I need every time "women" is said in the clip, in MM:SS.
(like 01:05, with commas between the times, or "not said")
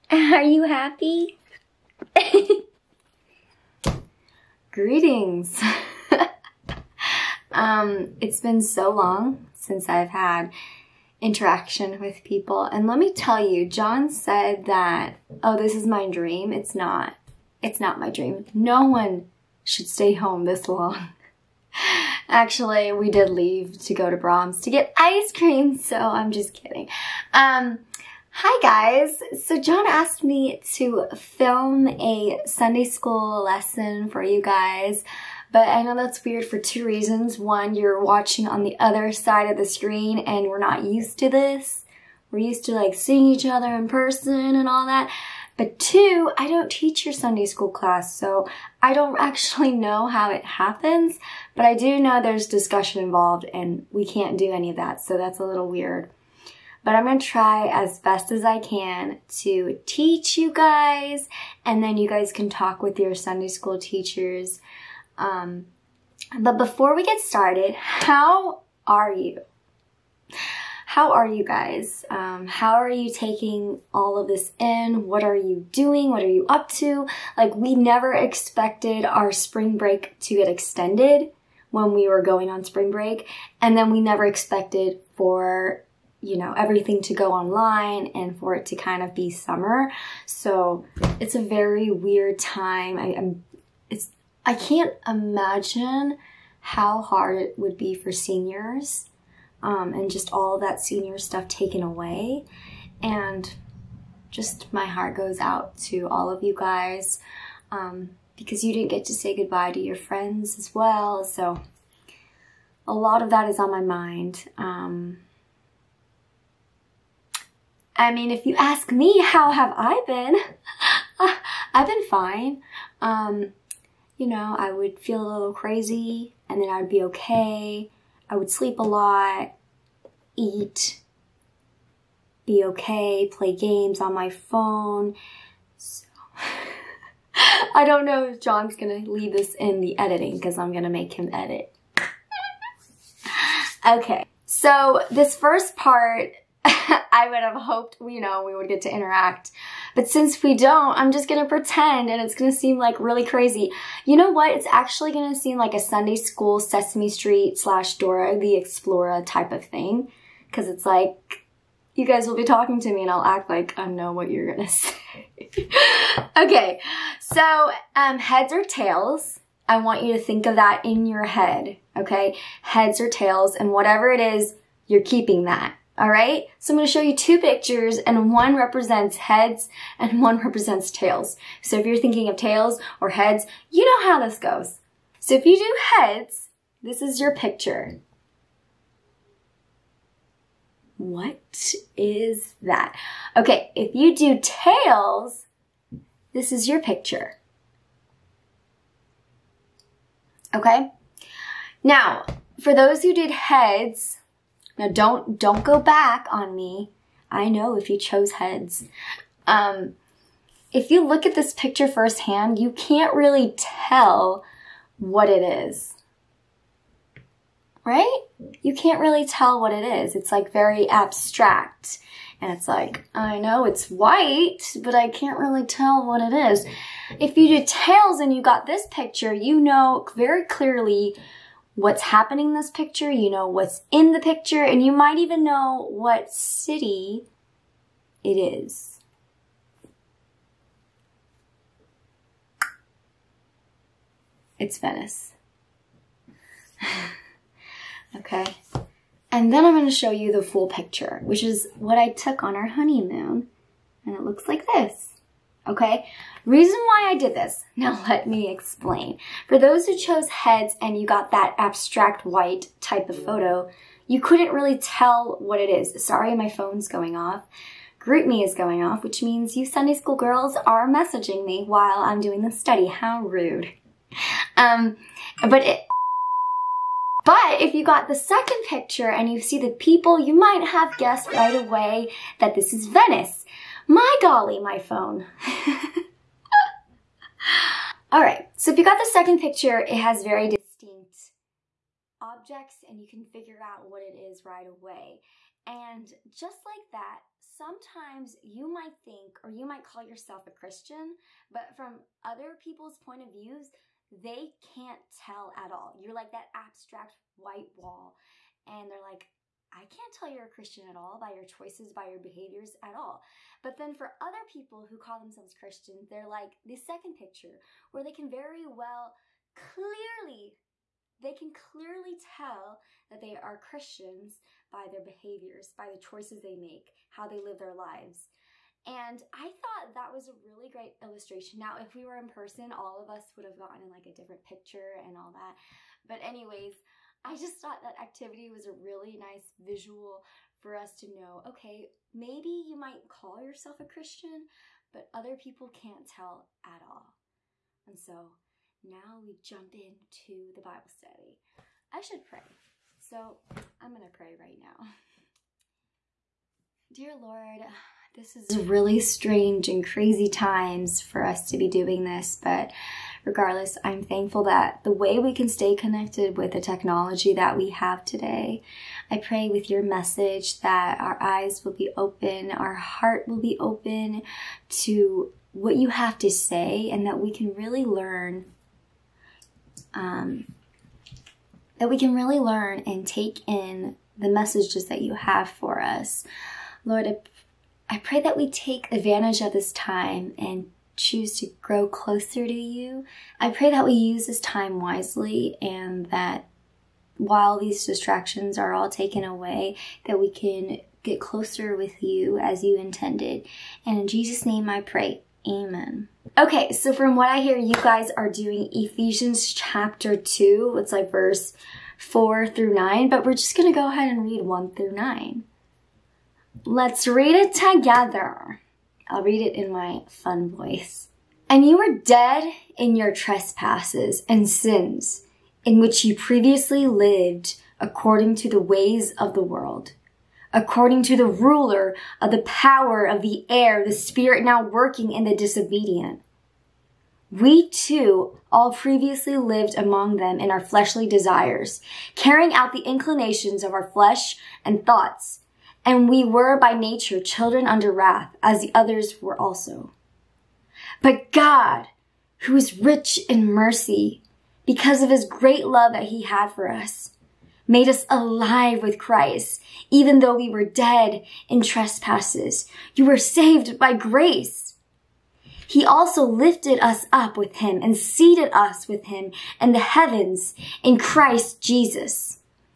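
not said.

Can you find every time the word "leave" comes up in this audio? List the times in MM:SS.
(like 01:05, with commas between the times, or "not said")
00:23, 02:19.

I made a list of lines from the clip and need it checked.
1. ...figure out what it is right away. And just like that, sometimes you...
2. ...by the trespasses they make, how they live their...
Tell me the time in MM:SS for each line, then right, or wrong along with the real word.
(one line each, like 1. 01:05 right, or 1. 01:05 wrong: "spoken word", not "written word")
1. 04:53 right
2. 05:25 wrong: "choices", not "trespasses".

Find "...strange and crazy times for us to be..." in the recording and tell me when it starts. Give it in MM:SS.
05:58.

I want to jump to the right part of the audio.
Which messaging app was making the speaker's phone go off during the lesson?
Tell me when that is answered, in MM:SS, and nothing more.
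04:27.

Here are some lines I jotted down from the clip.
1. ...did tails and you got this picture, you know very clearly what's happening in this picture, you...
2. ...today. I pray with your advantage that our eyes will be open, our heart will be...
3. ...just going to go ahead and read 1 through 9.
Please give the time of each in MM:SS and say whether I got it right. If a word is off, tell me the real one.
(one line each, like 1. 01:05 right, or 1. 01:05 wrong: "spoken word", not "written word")
1. 03:47 right
2. 06:08 wrong: "message", not "advantage"
3. 06:53 right.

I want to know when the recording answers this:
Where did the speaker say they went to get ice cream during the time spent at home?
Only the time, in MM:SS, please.
00:24.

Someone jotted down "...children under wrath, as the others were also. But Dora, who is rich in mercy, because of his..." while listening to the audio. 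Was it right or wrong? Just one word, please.
wrong.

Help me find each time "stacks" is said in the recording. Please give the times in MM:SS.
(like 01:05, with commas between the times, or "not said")
not said.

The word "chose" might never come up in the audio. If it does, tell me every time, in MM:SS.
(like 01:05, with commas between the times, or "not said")
03:27, 04:19.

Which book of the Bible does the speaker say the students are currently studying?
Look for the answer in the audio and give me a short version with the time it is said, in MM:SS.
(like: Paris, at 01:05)
Ephesians, at 06:48.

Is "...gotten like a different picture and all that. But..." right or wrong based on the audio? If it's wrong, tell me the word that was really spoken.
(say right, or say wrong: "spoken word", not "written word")
right.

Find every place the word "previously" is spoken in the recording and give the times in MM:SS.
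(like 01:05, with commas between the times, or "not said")
07:06, 07:18.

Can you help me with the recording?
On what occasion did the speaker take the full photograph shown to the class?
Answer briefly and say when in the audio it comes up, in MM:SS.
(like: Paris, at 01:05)
honeymoon, at 04:12.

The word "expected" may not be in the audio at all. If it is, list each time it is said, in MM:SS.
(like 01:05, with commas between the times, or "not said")
01:18, 01:24.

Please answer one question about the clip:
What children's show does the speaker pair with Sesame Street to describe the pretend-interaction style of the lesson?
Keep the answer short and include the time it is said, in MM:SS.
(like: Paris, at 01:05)
Dora the Explorer, at 02:37.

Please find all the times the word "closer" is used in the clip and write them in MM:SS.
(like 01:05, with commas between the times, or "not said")
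06:31, 06:41.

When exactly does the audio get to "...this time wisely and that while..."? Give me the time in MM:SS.
06:34.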